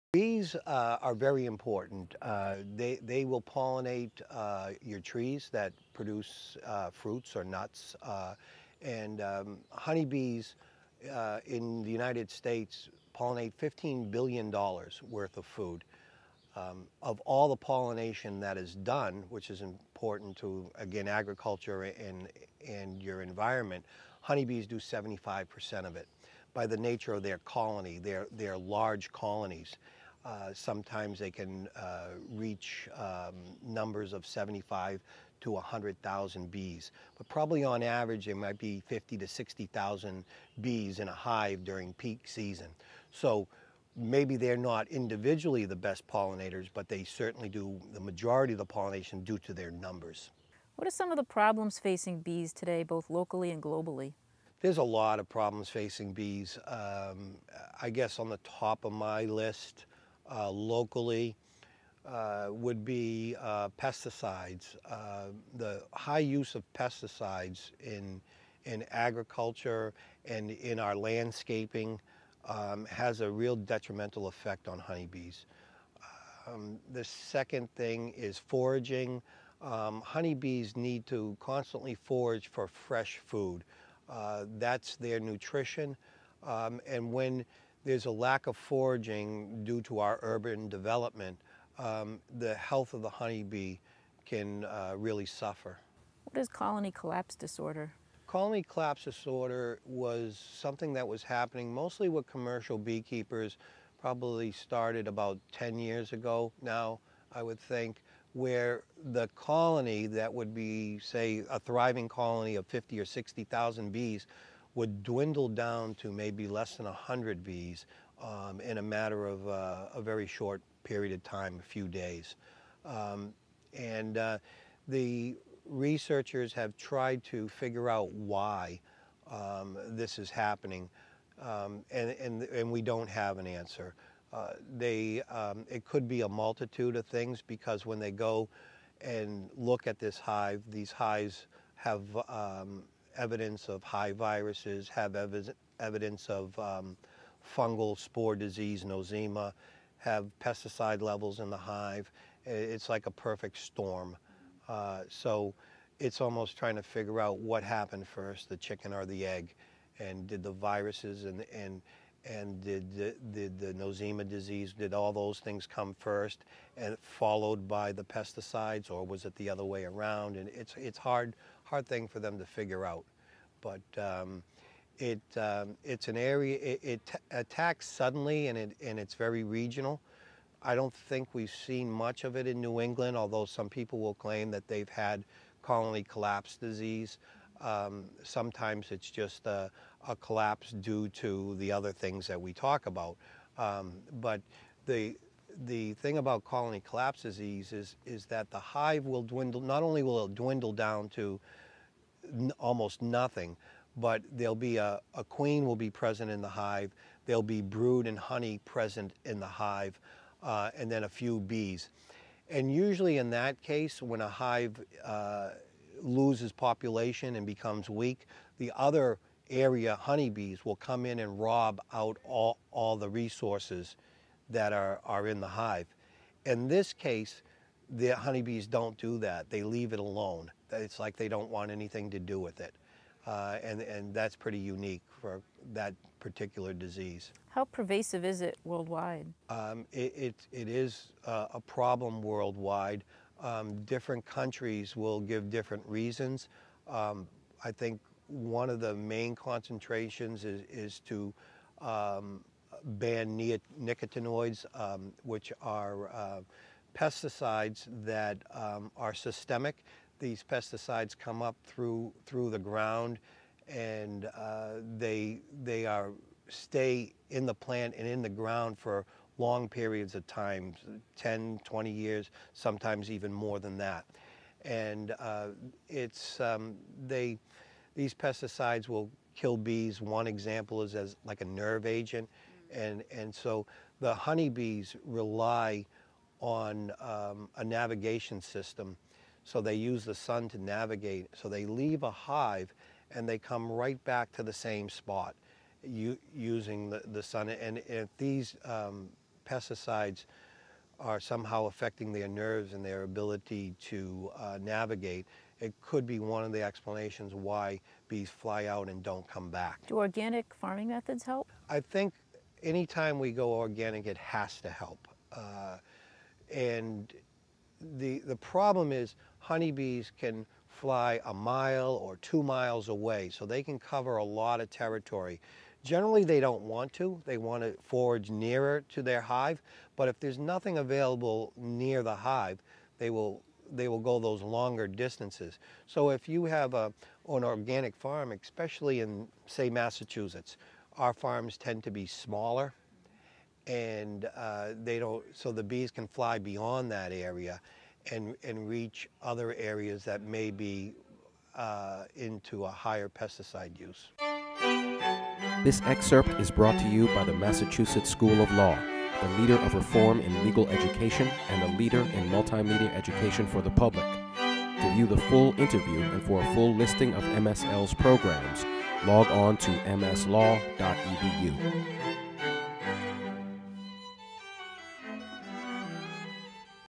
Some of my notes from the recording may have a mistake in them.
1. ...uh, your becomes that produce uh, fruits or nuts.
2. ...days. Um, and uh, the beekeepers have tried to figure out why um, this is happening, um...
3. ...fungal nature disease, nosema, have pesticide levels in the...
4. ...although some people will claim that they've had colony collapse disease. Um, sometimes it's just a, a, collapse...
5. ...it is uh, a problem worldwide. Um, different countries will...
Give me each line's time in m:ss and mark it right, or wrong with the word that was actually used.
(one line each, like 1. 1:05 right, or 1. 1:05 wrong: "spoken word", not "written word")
1. 0:04 wrong: "trees", not "becomes"
2. 2:01 wrong: "researchers", not "beekeepers"
3. 2:27 wrong: "spore", not "nature"
4. 3:03 right
5. 4:00 right.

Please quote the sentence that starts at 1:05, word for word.
the high use of pesticides in, in agriculture and in our landscaping um, has a real detrimental effect on honeybees.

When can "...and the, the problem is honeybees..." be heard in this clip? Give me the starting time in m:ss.
5:16.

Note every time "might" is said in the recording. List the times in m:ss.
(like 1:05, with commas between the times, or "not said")
0:38.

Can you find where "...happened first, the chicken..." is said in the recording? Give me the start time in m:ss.
2:37.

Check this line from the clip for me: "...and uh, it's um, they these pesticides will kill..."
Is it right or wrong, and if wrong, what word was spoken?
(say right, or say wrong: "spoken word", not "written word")
right.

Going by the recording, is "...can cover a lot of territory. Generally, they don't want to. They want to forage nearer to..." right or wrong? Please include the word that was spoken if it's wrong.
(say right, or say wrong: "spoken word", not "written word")
right.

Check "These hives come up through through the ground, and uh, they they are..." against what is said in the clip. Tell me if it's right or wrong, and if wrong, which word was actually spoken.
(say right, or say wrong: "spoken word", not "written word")
wrong: "pesticides", not "hives".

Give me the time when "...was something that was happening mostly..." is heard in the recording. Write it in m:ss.
1:39.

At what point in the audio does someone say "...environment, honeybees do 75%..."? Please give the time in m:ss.
0:23.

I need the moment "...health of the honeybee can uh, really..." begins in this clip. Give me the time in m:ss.
1:32.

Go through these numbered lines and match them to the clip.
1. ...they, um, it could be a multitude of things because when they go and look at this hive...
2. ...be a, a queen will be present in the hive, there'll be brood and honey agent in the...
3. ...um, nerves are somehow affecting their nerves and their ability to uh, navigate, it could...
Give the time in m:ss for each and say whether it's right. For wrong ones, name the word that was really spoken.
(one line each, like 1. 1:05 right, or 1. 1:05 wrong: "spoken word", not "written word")
1. 2:14 right
2. 3:24 wrong: "present", not "agent"
3. 4:58 wrong: "pesticides", not "nerves".